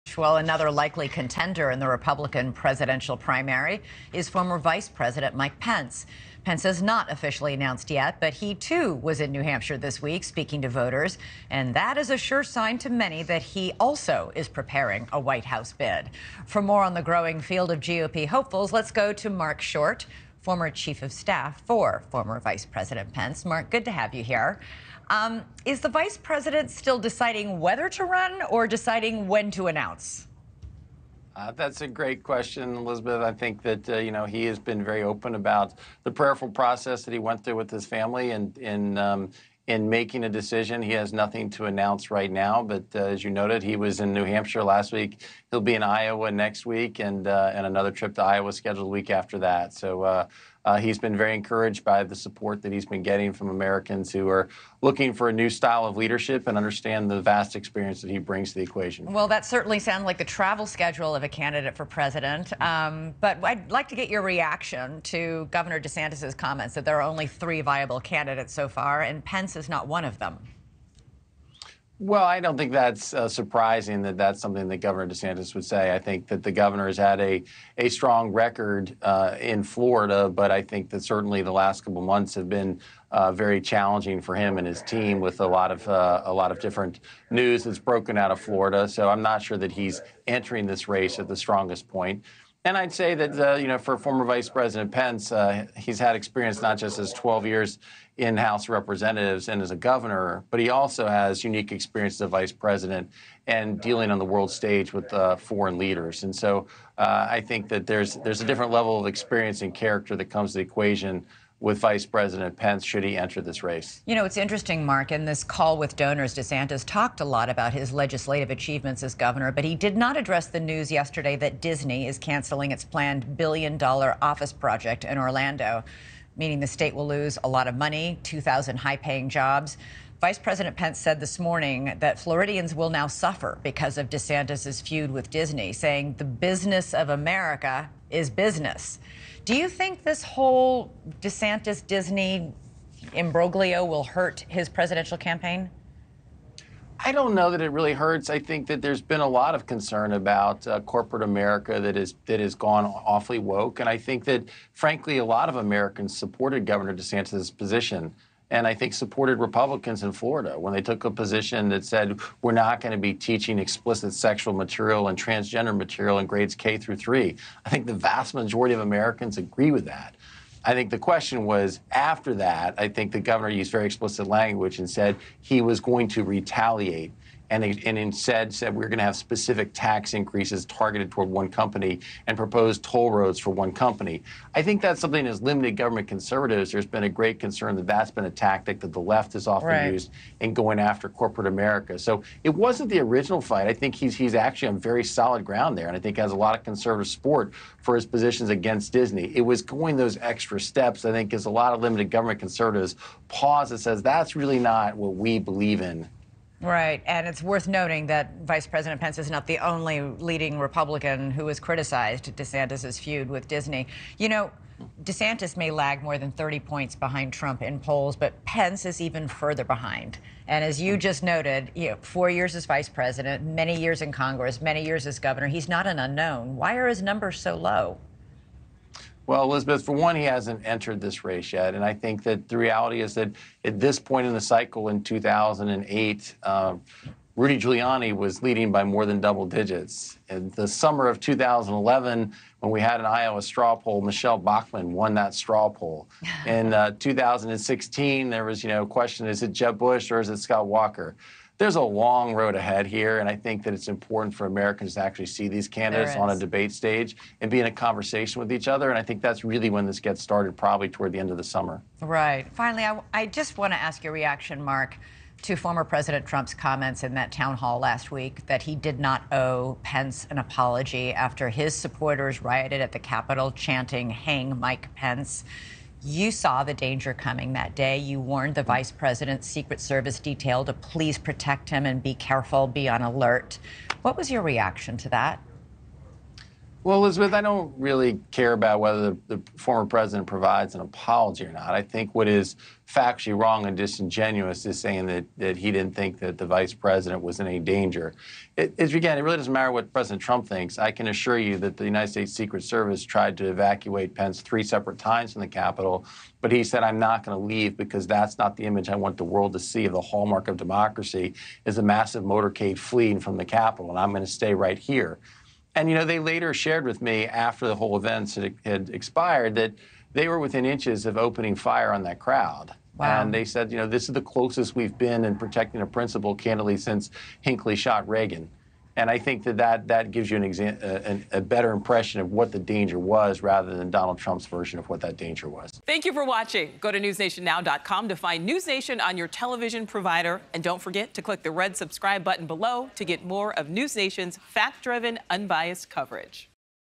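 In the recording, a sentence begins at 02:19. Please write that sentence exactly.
Do you think this whole DeSantis Disney imbroglio will hurt his presidential campaign?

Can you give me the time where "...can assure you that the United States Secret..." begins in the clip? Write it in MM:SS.
05:00.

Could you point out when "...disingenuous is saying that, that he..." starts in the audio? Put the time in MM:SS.
04:53.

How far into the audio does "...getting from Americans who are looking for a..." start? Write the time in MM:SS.
00:53.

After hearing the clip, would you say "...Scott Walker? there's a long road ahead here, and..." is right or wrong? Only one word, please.
right.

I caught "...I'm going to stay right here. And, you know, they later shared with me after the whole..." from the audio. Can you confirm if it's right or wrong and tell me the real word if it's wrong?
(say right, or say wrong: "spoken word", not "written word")
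right.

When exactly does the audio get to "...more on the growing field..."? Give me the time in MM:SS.
00:16.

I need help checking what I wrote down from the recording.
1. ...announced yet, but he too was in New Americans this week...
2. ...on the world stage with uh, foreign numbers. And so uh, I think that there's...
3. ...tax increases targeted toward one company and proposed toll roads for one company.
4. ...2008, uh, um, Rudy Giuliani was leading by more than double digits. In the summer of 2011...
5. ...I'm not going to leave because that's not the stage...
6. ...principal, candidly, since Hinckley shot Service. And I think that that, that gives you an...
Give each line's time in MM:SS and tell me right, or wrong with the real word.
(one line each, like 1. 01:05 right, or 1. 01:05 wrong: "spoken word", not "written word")
1. 00:07 wrong: "Hampshire", not "Americans"
2. 01:44 wrong: "leaders", not "numbers"
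3. 02:59 right
4. 03:55 right
5. 05:06 wrong: "image", not "stage"
6. 05:25 wrong: "Reagan", not "Service".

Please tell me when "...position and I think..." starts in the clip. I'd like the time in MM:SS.
02:37.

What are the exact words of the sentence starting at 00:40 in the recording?
He has nothing to announce right now, but uh, as you noted, he was in New Hampshire last week.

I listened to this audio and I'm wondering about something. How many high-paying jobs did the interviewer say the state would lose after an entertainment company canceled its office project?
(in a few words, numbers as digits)
2,000.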